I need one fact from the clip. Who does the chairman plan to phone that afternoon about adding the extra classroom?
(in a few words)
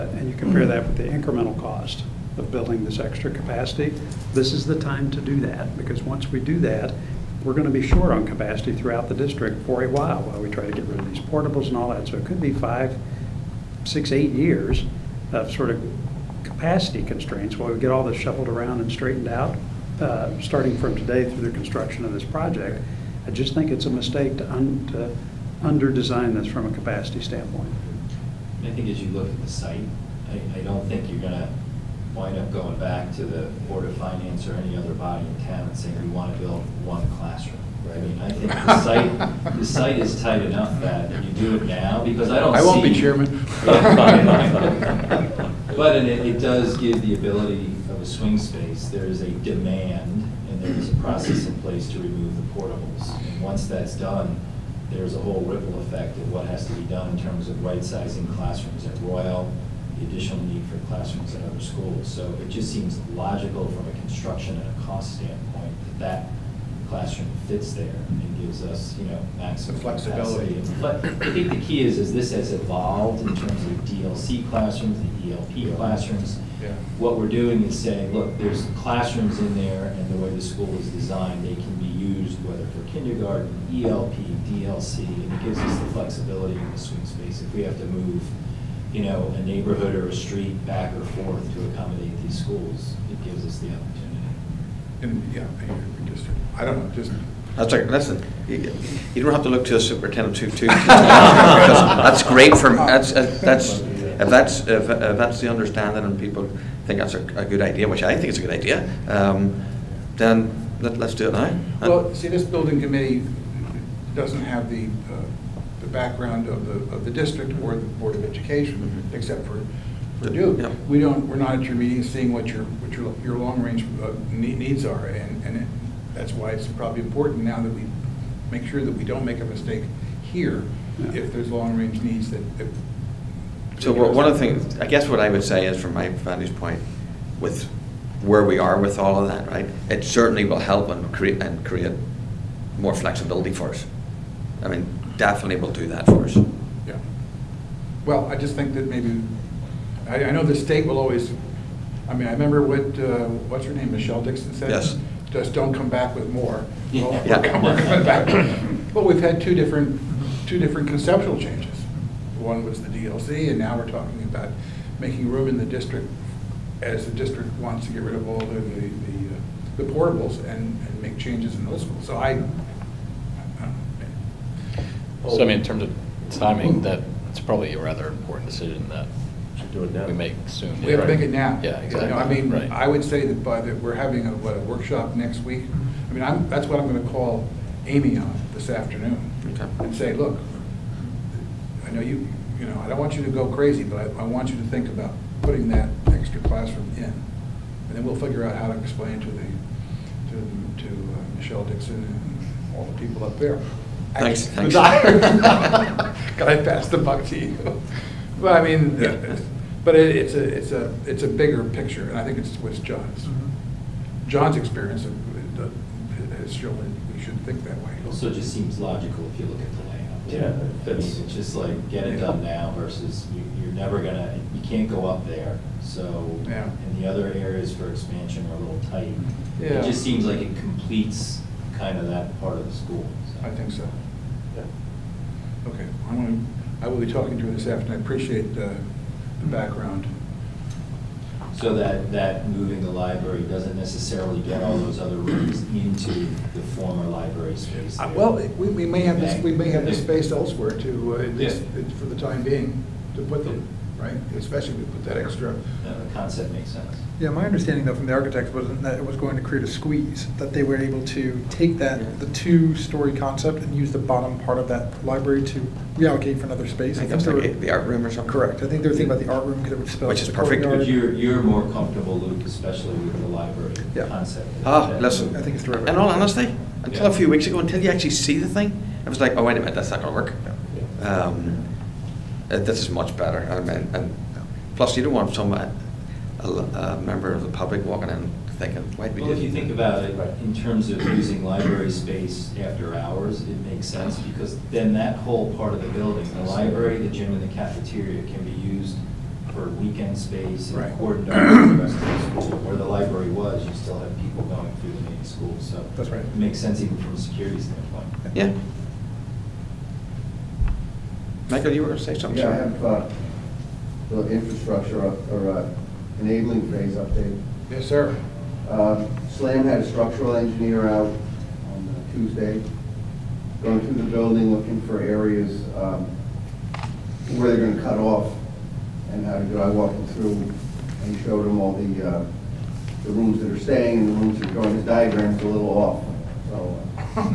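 Amy.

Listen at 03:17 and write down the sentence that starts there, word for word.
And then we'll figure out how to explain to the, to, to uh, Michelle Dixon and all the people up there Thanks.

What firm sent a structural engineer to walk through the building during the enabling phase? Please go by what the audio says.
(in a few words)
SLAM.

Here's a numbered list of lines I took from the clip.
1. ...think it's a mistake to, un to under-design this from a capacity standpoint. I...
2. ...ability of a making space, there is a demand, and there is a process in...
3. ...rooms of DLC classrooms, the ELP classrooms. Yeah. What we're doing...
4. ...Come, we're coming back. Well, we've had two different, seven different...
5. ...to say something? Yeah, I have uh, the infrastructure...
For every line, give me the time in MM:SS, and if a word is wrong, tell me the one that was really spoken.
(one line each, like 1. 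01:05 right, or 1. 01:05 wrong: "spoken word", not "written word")
1. 00:23 right
2. 00:47 wrong: "swing", not "making"
3. 01:13 wrong: "terms", not "rooms"
4. 02:37 wrong: "two", not "seven"
5. 05:11 right.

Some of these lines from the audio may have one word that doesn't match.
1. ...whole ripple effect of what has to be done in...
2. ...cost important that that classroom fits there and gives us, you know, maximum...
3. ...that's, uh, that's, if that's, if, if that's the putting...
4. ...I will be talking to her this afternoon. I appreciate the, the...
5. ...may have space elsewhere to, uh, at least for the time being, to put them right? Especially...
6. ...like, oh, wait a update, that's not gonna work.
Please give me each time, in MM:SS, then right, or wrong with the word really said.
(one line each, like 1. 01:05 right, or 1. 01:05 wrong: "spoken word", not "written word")
1. 00:55 right
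2. 01:04 wrong: "standpoint", not "important"
3. 01:42 wrong: "understanding", not "putting"
4. 03:56 right
5. 04:09 right
6. 04:39 wrong: "minute", not "update".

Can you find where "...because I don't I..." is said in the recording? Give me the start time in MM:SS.
00:42.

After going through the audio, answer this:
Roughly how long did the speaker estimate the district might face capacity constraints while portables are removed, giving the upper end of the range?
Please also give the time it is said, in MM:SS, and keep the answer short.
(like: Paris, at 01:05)
8 years, at 00:14.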